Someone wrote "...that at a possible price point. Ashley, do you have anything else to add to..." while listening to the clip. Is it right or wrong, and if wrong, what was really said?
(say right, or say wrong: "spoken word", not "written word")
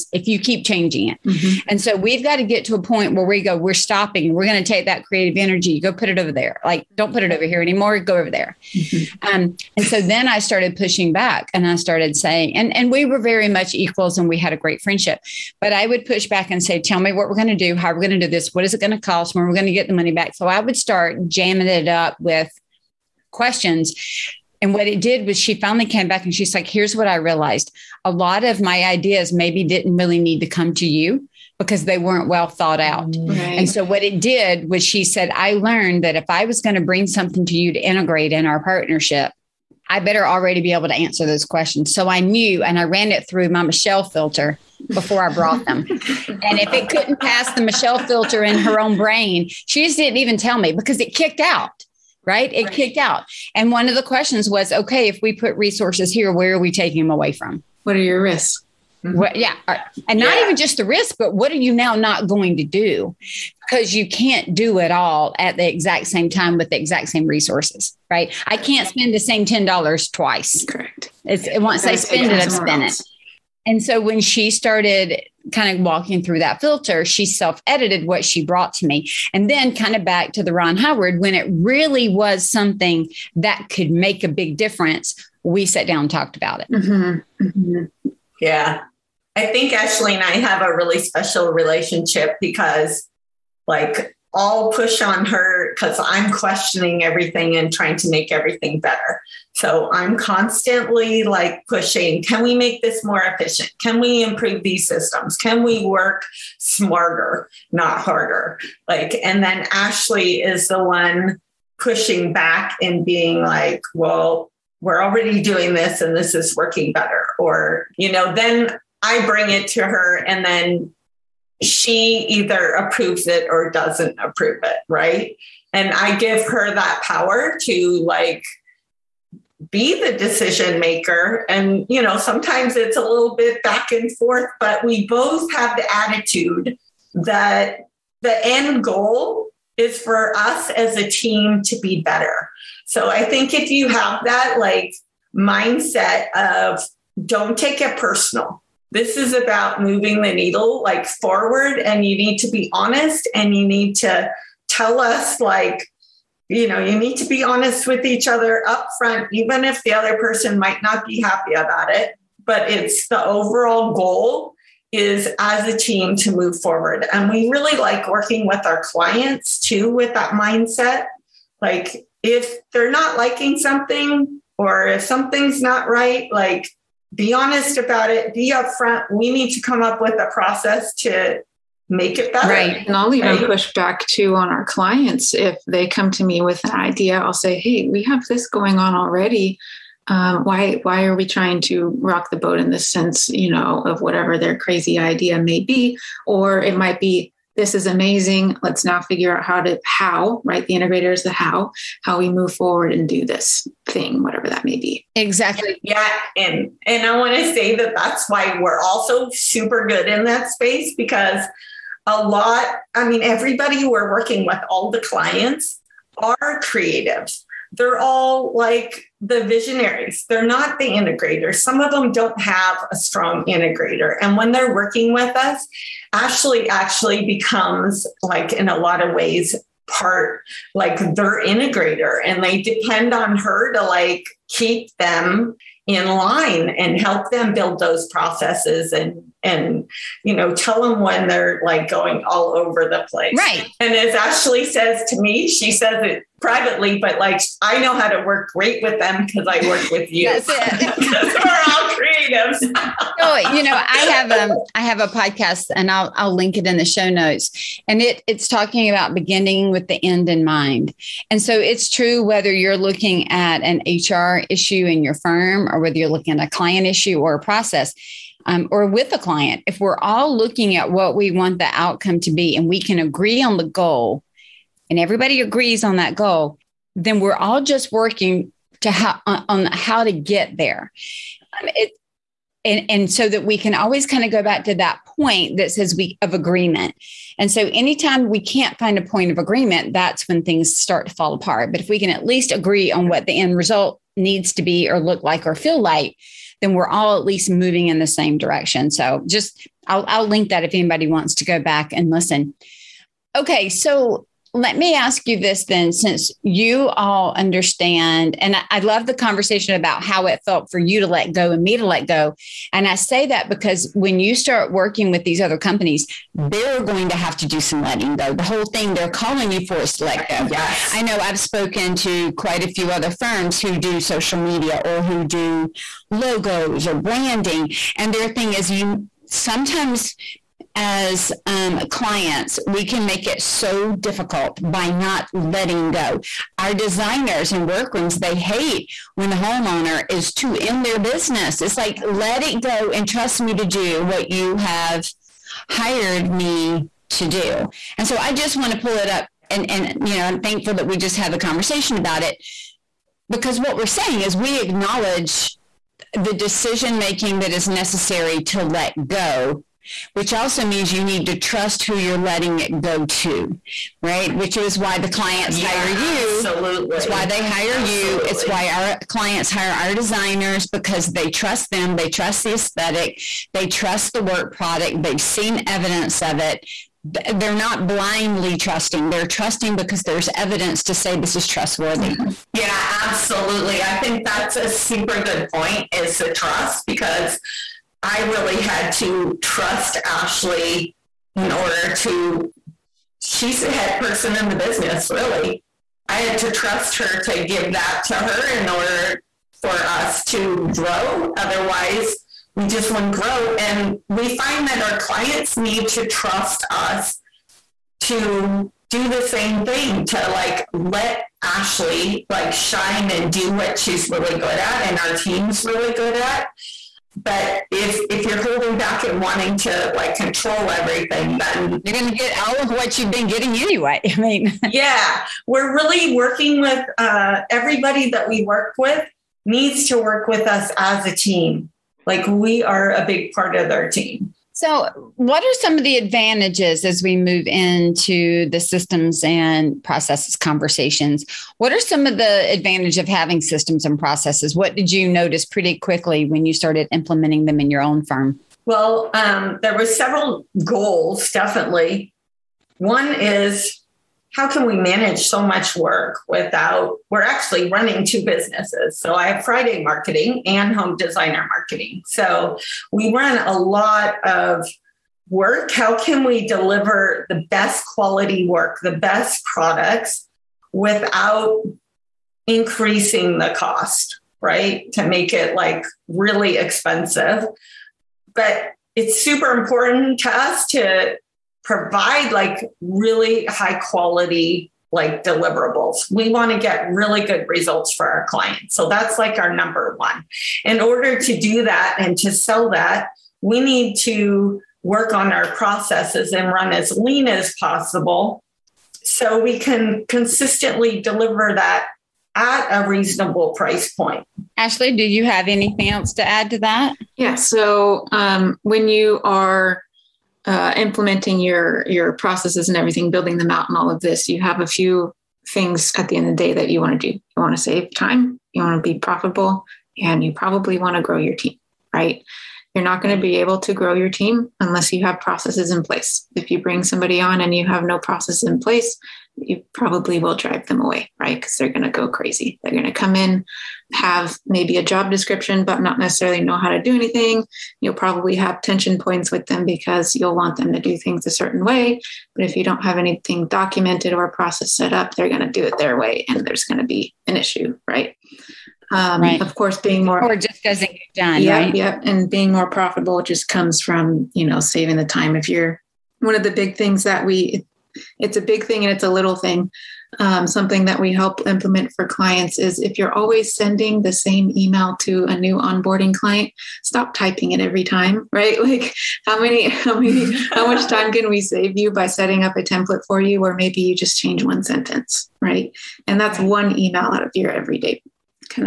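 wrong: "reasonable", not "possible".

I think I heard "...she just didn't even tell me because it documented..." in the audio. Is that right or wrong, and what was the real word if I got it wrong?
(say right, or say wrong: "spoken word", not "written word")
wrong: "kicked", not "documented".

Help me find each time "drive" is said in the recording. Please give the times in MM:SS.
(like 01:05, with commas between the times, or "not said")
08:50.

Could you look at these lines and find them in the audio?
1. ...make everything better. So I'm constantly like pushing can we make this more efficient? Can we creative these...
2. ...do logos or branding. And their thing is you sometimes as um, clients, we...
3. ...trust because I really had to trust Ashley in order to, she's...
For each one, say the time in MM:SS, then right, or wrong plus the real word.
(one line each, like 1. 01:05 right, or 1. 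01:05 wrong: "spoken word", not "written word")
1. 01:38 wrong: "improve", not "creative"
2. 05:25 right
3. 06:26 right.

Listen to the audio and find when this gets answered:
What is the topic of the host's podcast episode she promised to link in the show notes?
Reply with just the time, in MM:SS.
04:19.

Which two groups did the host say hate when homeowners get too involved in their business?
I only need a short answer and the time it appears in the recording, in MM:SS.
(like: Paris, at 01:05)
Designers and workrooms, at 05:36.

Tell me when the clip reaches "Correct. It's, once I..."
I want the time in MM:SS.
01:10.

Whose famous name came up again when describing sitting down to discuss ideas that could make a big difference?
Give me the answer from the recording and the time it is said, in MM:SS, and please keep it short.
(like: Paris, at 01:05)
Ron Howard, at 01:20.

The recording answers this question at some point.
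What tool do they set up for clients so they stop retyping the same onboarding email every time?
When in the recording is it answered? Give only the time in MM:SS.
09:32.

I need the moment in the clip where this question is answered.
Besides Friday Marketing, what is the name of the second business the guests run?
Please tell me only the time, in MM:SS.
07:40.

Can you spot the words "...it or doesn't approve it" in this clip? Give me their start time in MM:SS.
02:03.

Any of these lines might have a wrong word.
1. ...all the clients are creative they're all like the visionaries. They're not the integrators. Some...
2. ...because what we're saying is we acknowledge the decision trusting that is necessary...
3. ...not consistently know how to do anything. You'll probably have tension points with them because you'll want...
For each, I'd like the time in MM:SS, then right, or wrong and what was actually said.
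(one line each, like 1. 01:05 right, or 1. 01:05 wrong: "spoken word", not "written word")
1. 03:34 right
2. 05:53 wrong: "making", not "trusting"
3. 08:55 wrong: "necessarily", not "consistently".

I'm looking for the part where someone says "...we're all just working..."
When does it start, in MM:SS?
04:37.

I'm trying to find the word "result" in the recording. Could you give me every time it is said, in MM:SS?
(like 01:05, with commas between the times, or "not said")
04:53, 08:07.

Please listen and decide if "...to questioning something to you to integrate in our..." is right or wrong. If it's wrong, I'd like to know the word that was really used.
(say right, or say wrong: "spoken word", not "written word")
wrong: "bring", not "questioning".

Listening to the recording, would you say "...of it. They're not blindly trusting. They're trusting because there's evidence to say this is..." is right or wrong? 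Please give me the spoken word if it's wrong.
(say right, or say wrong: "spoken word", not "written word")
right.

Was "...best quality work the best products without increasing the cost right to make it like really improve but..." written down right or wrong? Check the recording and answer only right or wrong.
wrong.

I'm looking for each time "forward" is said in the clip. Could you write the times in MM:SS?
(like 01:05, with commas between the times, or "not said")
02:31, 02:46, 03:22.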